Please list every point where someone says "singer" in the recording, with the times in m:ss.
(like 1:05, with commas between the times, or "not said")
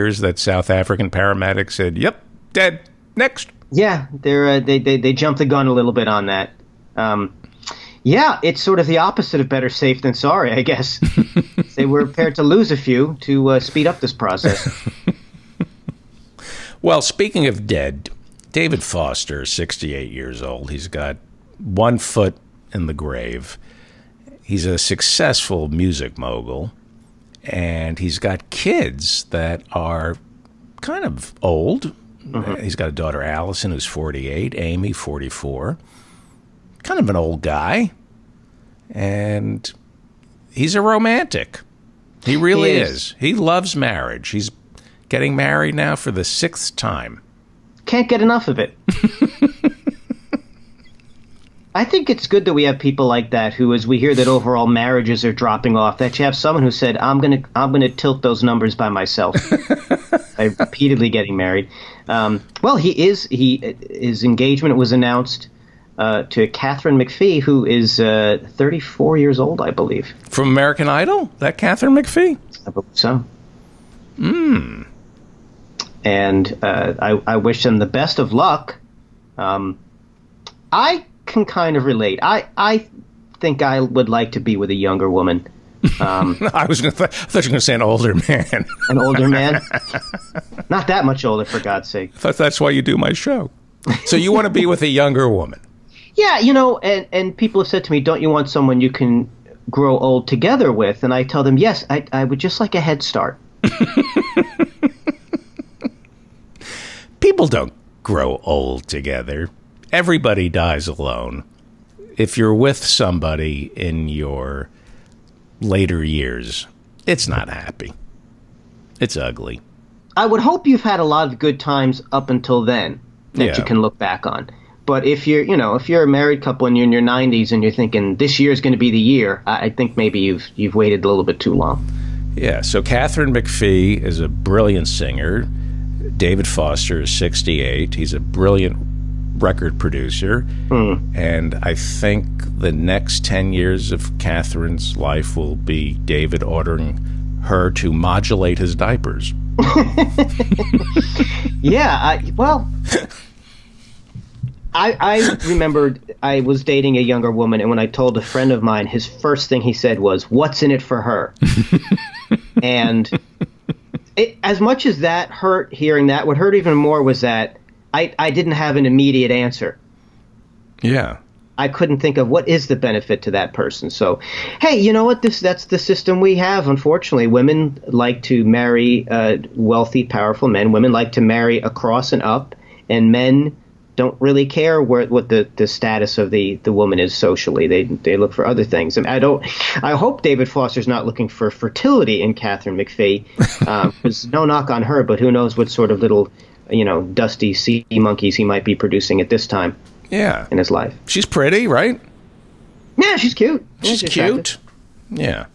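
2:14.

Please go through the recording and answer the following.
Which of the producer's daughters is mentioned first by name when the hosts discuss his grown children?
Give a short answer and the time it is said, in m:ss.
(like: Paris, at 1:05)
Allison, at 0:33.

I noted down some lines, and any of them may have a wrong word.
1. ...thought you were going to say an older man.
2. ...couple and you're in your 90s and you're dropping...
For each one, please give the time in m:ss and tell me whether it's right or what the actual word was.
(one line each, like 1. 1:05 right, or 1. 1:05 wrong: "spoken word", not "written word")
1. 1:27 right
2. 2:06 wrong: "thinking", not "dropping".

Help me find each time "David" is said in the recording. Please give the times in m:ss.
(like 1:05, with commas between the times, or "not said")
0:18, 2:16, 2:26, 3:10.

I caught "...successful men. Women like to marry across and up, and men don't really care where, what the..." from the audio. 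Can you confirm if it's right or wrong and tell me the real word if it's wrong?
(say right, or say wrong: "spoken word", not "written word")
wrong: "powerful", not "successful".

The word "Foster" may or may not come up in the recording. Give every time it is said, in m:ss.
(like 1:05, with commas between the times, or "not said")
0:18, 2:16, 3:10.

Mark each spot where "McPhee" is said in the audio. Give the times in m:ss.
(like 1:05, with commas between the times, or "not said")
1:06, 1:11, 2:13, 3:12.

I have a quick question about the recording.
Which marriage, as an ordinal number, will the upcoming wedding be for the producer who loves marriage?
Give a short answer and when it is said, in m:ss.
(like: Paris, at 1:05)
sixth, at 0:46.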